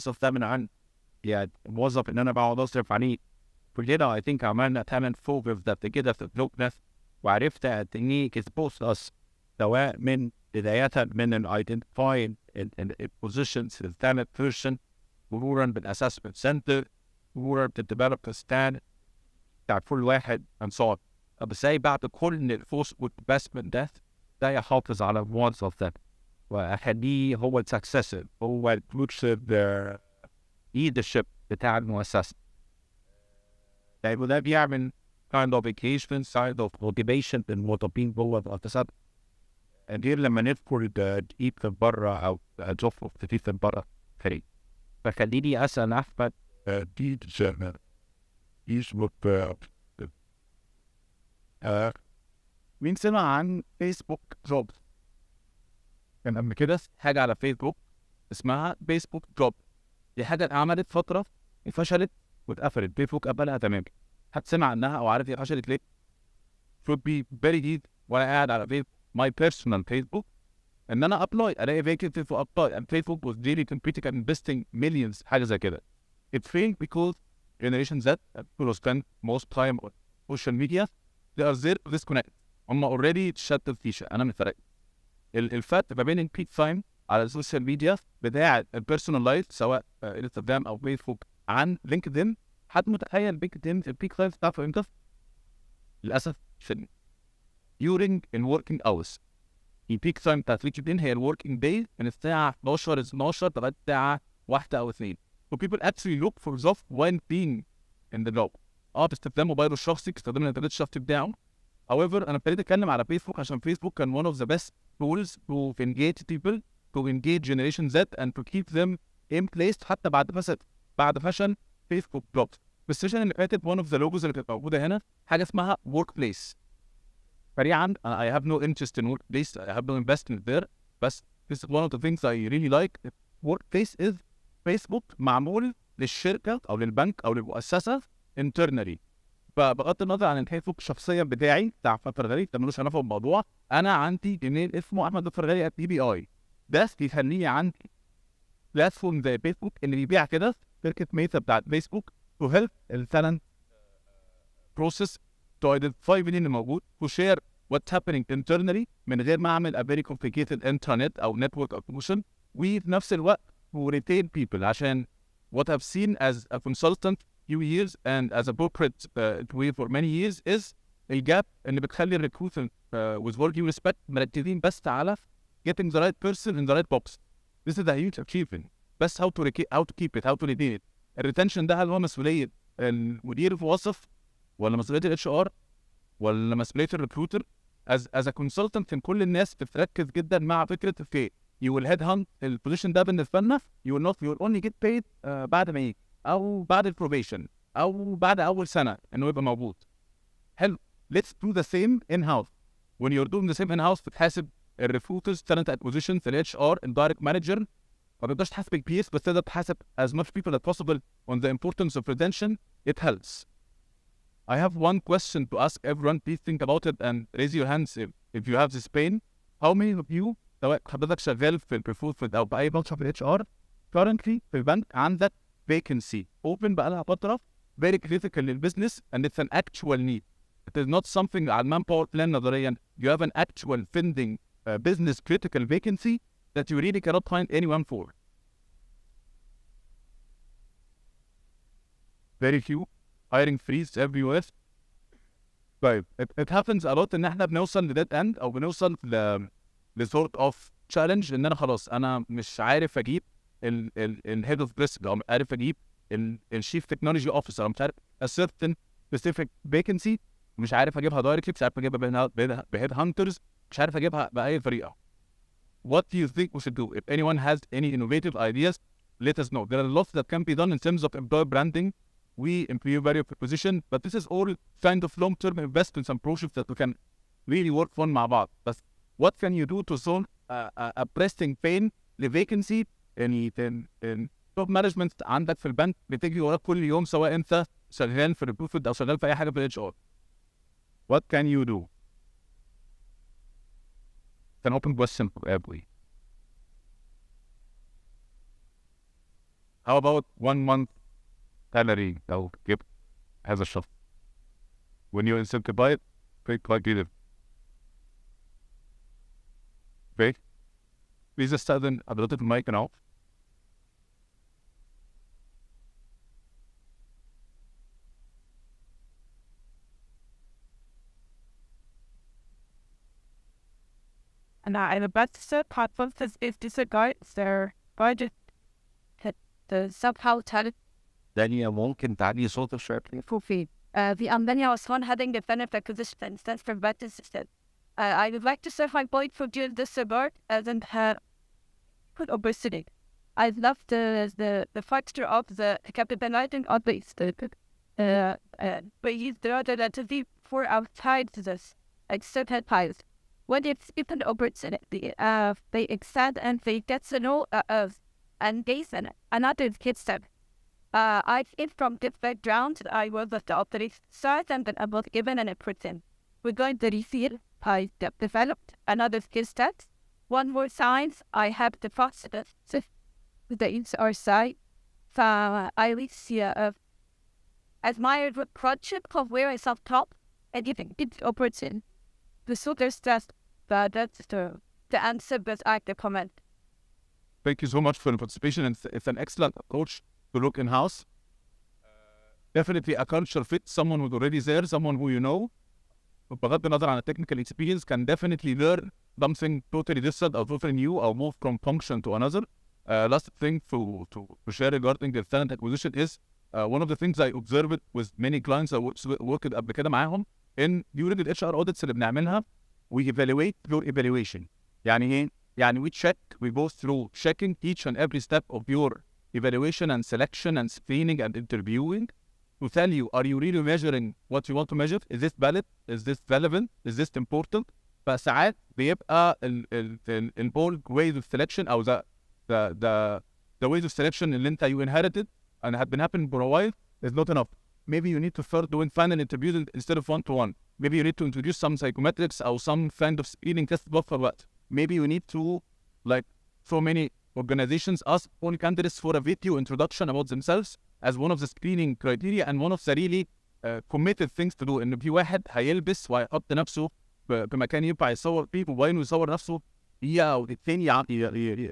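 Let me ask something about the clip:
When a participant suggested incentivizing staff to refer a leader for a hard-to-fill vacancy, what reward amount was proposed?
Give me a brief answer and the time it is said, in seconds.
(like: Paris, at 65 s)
one month salary, at 300 s.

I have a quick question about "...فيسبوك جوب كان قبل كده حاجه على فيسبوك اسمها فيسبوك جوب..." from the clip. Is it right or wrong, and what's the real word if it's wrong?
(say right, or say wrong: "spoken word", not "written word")
right.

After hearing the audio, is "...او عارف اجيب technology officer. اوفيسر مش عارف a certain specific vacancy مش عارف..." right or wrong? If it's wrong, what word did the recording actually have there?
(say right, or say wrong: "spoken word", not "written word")
right.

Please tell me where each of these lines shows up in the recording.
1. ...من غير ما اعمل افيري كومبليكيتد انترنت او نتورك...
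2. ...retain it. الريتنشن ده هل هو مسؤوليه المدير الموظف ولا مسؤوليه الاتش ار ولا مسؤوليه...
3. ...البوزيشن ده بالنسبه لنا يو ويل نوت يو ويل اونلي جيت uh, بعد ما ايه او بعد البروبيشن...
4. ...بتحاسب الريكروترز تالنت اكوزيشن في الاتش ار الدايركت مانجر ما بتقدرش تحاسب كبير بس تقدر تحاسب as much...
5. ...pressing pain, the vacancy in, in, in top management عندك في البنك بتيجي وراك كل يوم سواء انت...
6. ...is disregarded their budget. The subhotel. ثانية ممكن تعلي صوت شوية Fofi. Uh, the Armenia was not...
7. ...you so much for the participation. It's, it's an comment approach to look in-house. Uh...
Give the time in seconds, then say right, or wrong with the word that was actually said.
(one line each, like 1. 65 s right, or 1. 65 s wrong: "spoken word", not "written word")
1. 159 s right
2. 180 s right
3. 192 s right
4. 204 s right
5. 281 s right
6. 326 s right
7. 387 s wrong: "excellent", not "comment".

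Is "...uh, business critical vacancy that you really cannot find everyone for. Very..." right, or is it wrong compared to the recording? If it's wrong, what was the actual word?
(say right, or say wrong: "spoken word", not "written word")
wrong: "anyone", not "everyone".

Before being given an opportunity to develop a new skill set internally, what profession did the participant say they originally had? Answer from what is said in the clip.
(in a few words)
doctor.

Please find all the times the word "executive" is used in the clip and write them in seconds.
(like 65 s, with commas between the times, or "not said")
not said.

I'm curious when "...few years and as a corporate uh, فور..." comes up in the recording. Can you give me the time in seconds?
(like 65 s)
167 s.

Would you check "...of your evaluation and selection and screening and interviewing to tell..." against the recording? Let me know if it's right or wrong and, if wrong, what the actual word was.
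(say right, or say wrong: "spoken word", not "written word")
right.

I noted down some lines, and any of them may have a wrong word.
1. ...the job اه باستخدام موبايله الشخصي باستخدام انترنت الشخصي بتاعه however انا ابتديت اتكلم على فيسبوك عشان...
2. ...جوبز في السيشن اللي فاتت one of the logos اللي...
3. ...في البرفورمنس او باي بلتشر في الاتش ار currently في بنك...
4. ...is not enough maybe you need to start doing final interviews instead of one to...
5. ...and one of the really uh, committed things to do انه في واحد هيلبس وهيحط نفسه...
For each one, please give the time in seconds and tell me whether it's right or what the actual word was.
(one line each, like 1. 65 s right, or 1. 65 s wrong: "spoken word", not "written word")
1. 108 s wrong: "الانترنت", not "انترنت"
2. 122 s right
3. 221 s right
4. 437 s right
5. 452 s right.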